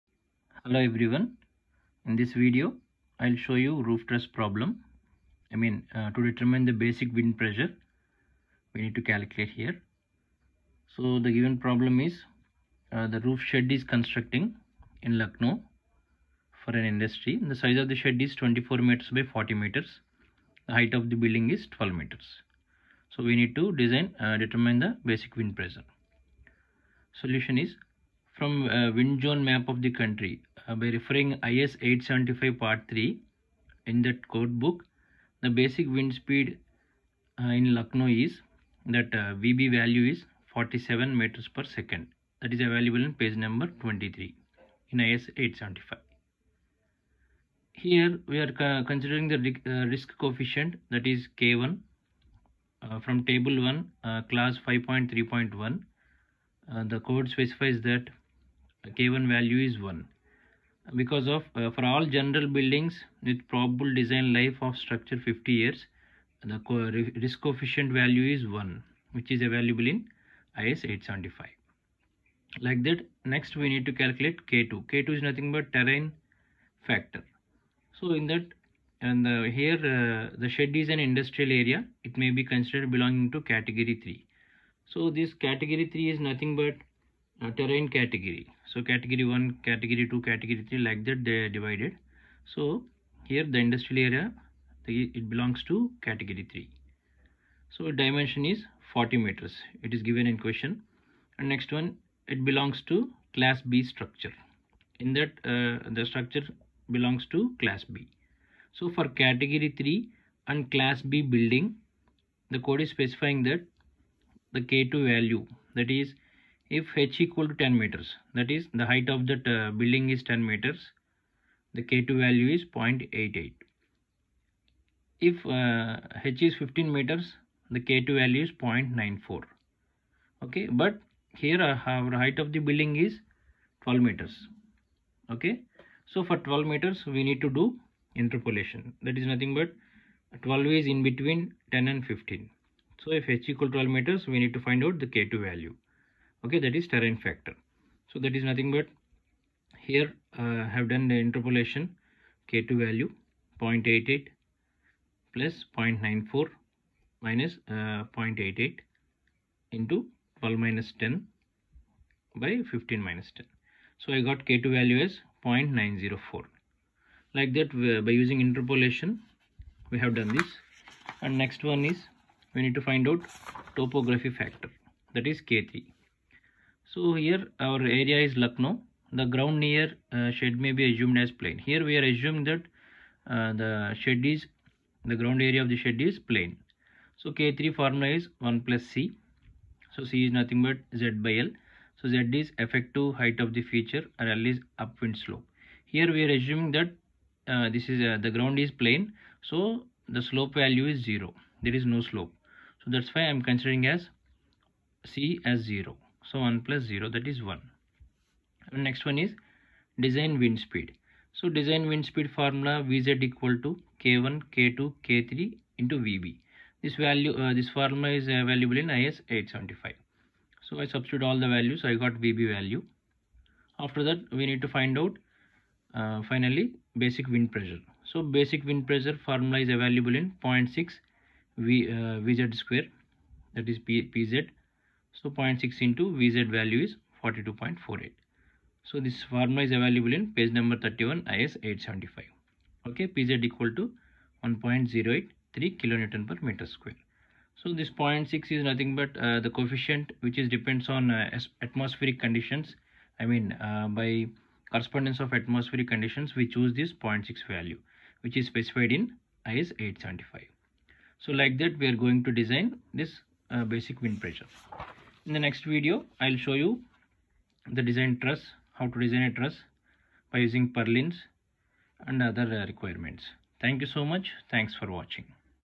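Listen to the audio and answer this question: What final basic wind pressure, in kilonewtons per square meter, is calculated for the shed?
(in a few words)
1.083.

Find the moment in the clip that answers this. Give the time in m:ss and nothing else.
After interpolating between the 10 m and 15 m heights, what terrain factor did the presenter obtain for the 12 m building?
2:45.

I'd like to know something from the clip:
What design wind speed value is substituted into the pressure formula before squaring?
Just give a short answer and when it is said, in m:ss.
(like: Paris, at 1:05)
42.48, at 3:57.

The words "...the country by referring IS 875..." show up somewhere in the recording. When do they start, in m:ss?
0:29.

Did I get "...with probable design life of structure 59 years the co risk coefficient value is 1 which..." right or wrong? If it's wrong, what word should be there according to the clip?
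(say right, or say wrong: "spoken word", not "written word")
wrong: "50", not "59".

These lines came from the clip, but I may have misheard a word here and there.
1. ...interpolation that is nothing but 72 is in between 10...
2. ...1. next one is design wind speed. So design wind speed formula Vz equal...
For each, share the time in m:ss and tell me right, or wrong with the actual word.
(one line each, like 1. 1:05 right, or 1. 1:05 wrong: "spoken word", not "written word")
1. 2:18 wrong: "12", not "72"
2. 3:27 right.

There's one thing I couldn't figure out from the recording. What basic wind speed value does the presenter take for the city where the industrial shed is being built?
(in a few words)
47 m/s.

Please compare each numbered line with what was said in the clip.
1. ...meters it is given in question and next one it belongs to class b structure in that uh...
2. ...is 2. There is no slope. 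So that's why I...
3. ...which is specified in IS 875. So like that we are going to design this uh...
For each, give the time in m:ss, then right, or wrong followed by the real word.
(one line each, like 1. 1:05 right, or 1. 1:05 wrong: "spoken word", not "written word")
1. 1:39 right
2. 3:20 wrong: "0", not "2"
3. 4:18 right.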